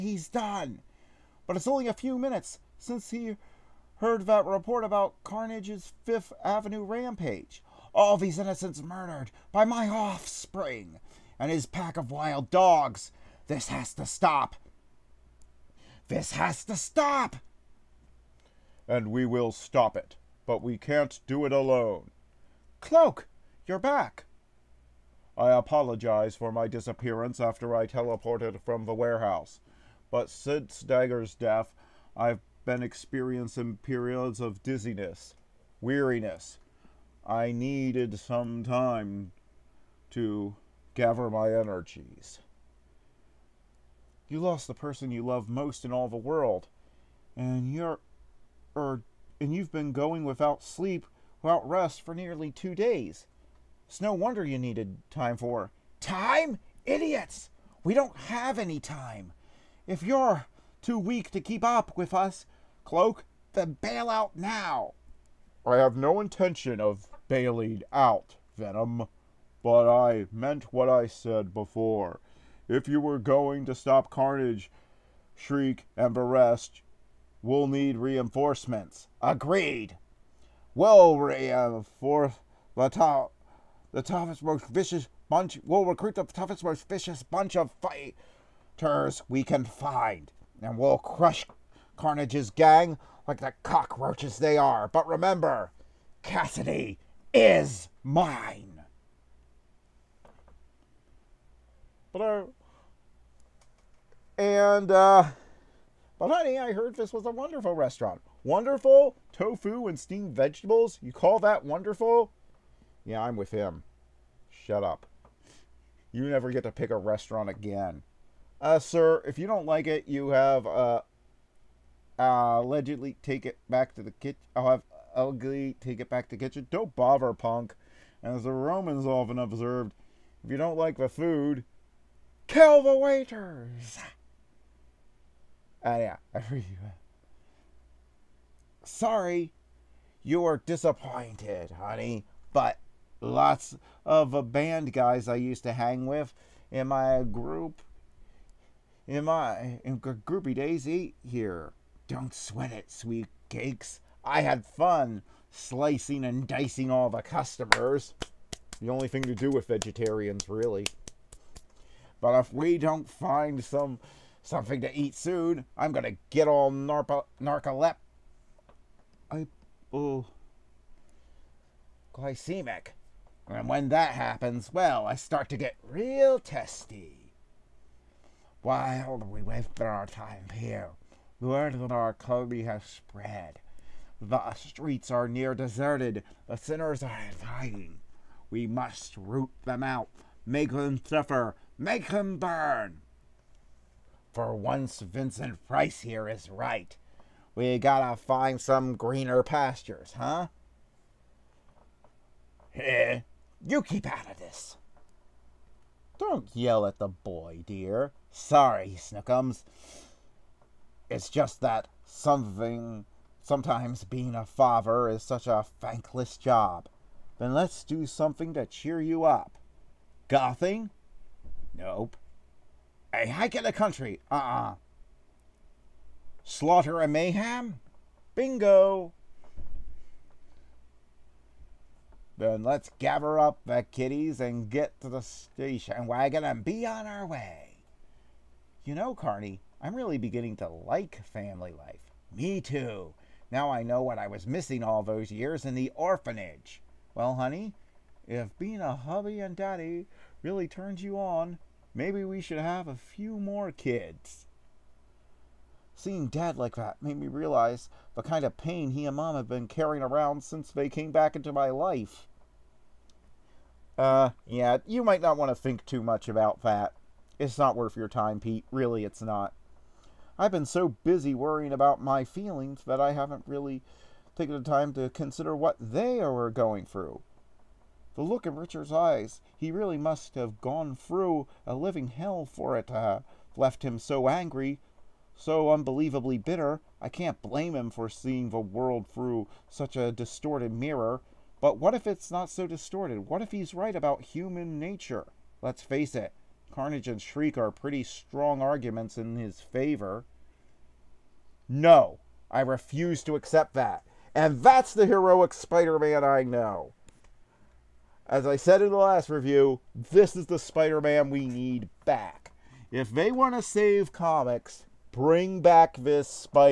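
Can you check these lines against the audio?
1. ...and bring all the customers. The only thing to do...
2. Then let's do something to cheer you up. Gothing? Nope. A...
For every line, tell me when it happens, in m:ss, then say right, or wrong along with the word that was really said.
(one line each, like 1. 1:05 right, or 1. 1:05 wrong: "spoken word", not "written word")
1. 2:36 wrong: "dicing", not "bring"
2. 3:37 right.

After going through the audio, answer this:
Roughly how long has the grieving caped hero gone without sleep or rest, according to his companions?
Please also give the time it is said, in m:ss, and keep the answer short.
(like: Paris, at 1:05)
Nearly two days, at 0:52.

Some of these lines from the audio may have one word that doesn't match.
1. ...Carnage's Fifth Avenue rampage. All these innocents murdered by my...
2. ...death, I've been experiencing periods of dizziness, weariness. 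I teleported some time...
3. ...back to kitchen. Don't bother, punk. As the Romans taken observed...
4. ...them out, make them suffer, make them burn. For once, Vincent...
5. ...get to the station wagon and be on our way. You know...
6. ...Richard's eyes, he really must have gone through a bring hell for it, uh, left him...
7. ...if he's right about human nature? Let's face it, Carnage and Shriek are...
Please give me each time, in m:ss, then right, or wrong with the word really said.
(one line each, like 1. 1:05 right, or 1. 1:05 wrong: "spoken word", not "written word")
1. 0:05 right
2. 0:31 wrong: "needed", not "teleported"
3. 2:06 wrong: "often", not "taken"
4. 3:09 right
5. 3:54 right
6. 4:38 wrong: "living", not "bring"
7. 4:53 right.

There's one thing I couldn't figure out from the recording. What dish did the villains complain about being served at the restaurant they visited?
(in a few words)
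Tofu and steamed vegetables.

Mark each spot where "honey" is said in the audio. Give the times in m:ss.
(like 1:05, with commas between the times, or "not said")
1:46, 2:21, 4:07.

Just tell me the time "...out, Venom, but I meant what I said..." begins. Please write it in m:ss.
1:07.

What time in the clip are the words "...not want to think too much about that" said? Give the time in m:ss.
4:25.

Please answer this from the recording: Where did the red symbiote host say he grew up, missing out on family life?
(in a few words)
The orphanage.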